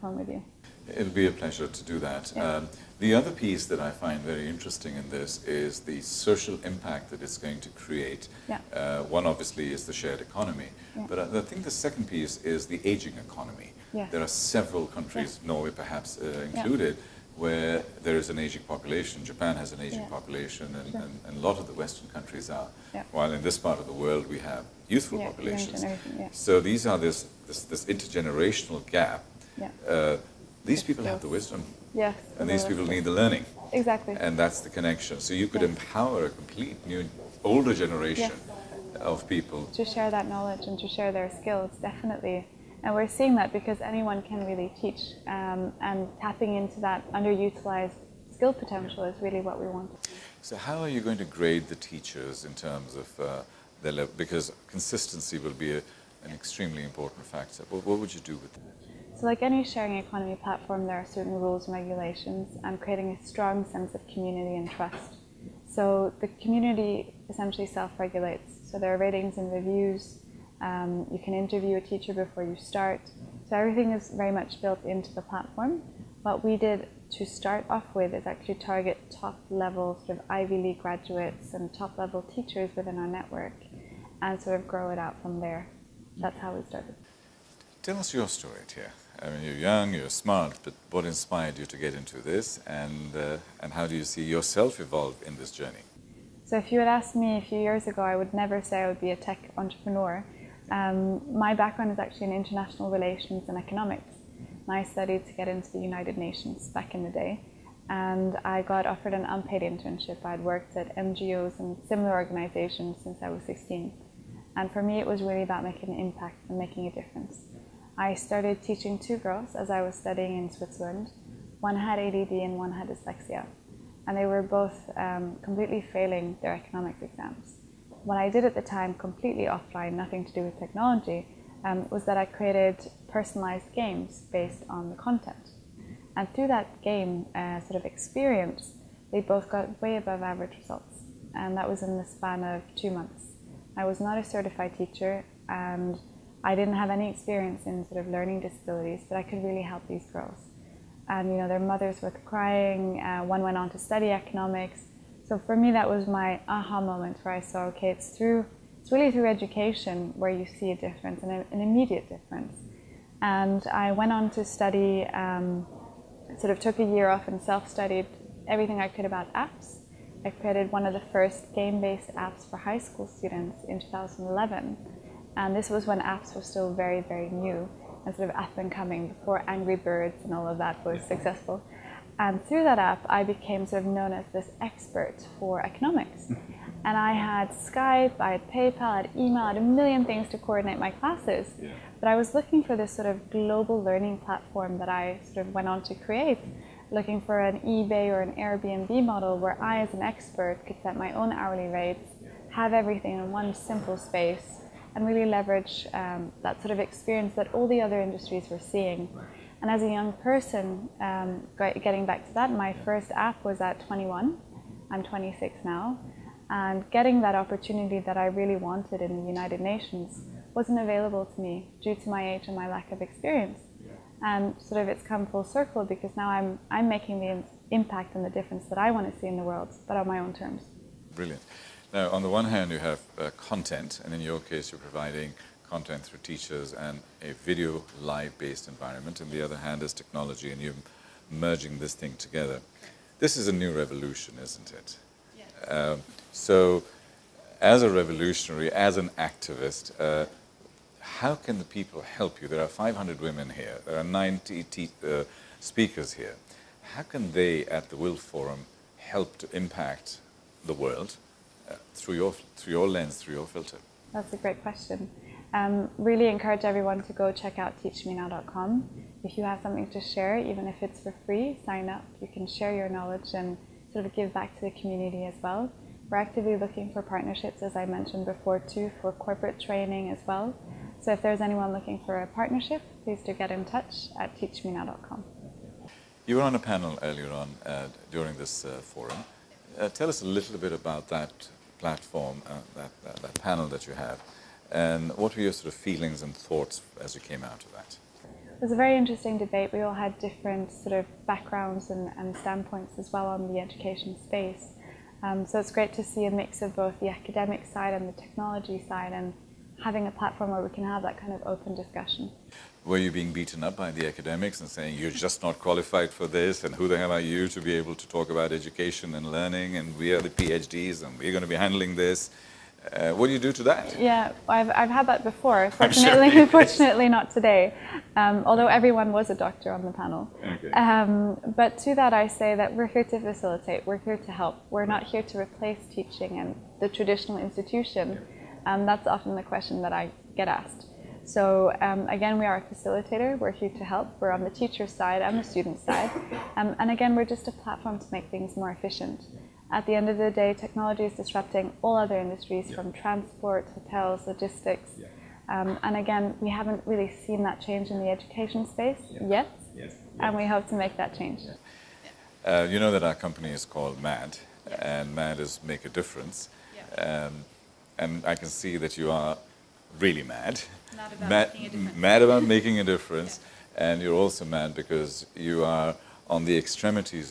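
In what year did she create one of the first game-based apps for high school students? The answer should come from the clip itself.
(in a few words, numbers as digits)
2011.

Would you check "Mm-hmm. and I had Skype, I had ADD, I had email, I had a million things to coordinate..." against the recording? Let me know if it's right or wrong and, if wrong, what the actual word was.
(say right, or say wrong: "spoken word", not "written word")
wrong: "PayPal", not "ADD".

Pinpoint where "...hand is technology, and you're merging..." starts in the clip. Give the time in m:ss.
3:59.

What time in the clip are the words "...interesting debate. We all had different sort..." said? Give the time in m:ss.
4:58.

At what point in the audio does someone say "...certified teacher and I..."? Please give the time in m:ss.
2:24.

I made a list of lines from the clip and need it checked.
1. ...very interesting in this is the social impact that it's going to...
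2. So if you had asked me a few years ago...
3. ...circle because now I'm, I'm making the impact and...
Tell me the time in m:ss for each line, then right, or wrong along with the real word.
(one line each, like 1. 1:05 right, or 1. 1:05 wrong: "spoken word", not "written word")
1. 0:04 right
2. 1:36 right
3. 3:45 right.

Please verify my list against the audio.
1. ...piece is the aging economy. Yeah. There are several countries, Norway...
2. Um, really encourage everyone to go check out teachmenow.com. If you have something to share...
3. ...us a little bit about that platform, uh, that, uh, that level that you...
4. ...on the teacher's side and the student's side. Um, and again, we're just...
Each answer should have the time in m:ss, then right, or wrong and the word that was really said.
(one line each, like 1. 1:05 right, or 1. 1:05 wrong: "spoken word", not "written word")
1. 0:12 right
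2. 4:25 right
3. 4:50 wrong: "panel", not "level"
4. 5:44 right.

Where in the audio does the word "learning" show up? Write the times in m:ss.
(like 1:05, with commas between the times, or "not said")
0:33, 2:28, 3:13, 5:19.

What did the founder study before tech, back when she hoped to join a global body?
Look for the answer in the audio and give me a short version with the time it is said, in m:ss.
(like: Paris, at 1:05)
International relations and economics, at 1:42.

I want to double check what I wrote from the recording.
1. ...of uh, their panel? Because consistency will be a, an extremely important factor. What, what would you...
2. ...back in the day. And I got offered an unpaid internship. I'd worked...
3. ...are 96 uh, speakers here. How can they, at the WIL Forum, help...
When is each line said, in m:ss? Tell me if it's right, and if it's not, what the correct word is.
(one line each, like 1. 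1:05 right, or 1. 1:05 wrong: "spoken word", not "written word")
1. 0:52 wrong: "level", not "panel"
2. 1:46 right
3. 4:13 wrong: "90", not "96".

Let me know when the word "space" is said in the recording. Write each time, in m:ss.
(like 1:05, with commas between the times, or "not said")
3:23, 5:04, 5:58.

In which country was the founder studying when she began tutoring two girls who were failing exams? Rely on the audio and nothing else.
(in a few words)
Switzerland.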